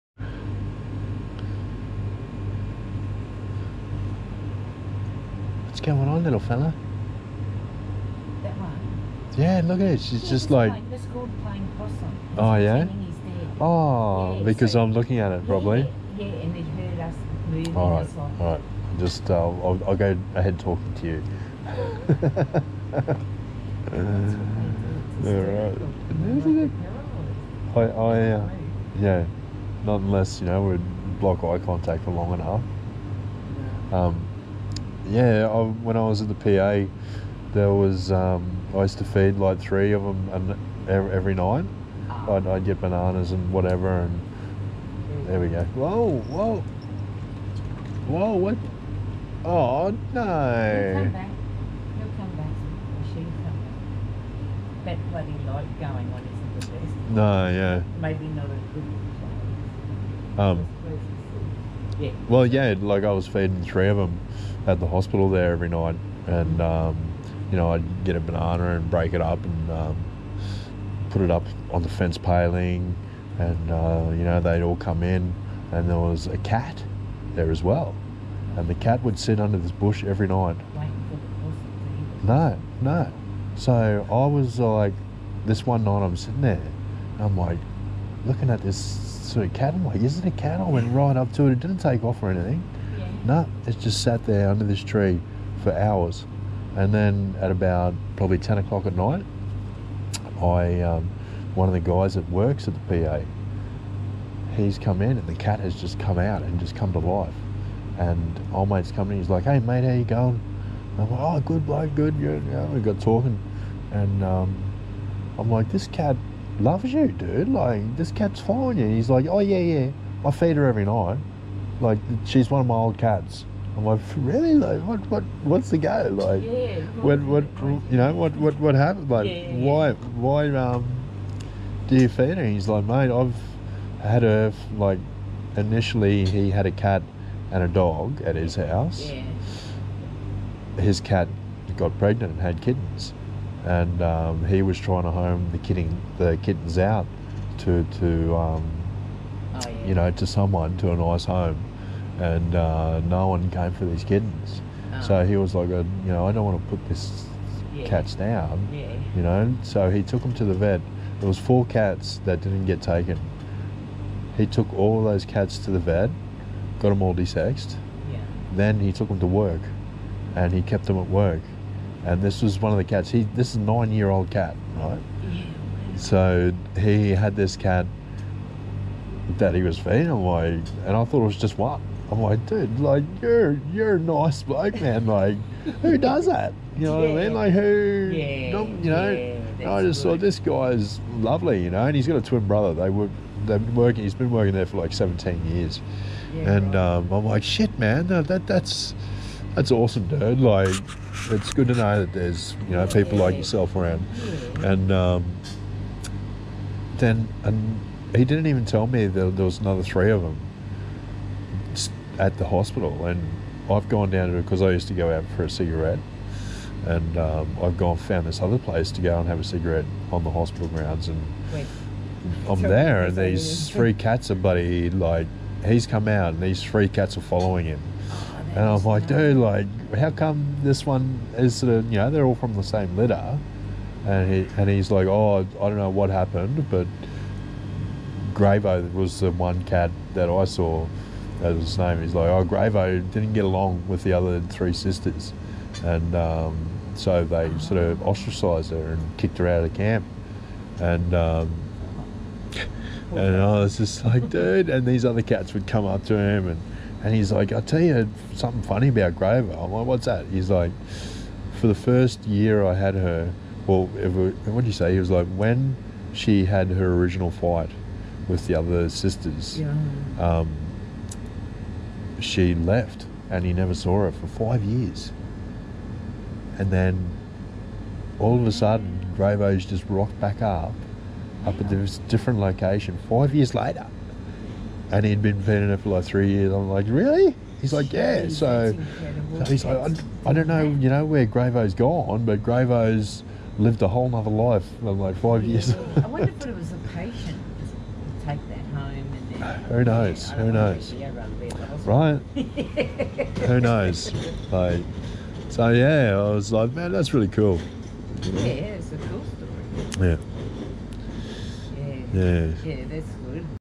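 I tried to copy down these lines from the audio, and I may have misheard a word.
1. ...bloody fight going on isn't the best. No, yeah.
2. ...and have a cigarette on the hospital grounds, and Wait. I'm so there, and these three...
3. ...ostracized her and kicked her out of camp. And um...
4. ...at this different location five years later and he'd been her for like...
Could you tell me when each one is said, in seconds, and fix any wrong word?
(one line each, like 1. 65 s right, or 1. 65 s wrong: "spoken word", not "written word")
1. 55 s wrong: "light", not "fight"
2. 219 s right
3. 248 s right
4. 281 s right.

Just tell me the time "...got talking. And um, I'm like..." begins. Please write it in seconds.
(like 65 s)
112 s.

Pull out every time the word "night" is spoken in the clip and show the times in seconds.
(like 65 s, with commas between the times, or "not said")
41 s, 65 s, 80 s, 85 s, 98 s, 120 s.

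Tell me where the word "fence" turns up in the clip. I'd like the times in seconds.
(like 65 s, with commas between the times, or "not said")
71 s.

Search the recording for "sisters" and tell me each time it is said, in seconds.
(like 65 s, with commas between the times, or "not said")
244 s, 268 s.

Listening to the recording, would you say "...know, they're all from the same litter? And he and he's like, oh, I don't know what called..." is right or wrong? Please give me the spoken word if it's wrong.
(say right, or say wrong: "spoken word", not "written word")
wrong: "happened", not "called".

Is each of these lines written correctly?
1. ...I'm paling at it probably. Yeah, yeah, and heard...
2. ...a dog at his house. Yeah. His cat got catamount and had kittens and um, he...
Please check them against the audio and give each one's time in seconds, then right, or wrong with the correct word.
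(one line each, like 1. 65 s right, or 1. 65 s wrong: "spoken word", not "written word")
1. 14 s wrong: "looking", not "paling"
2. 137 s wrong: "pregnant", not "catamount".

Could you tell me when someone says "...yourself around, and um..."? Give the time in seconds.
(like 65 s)
203 s.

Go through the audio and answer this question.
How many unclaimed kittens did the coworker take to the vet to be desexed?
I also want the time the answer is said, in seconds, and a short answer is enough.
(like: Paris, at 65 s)
4, at 161 s.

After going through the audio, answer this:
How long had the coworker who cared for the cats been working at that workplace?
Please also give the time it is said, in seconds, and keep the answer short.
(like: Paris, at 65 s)
17 years, at 194 s.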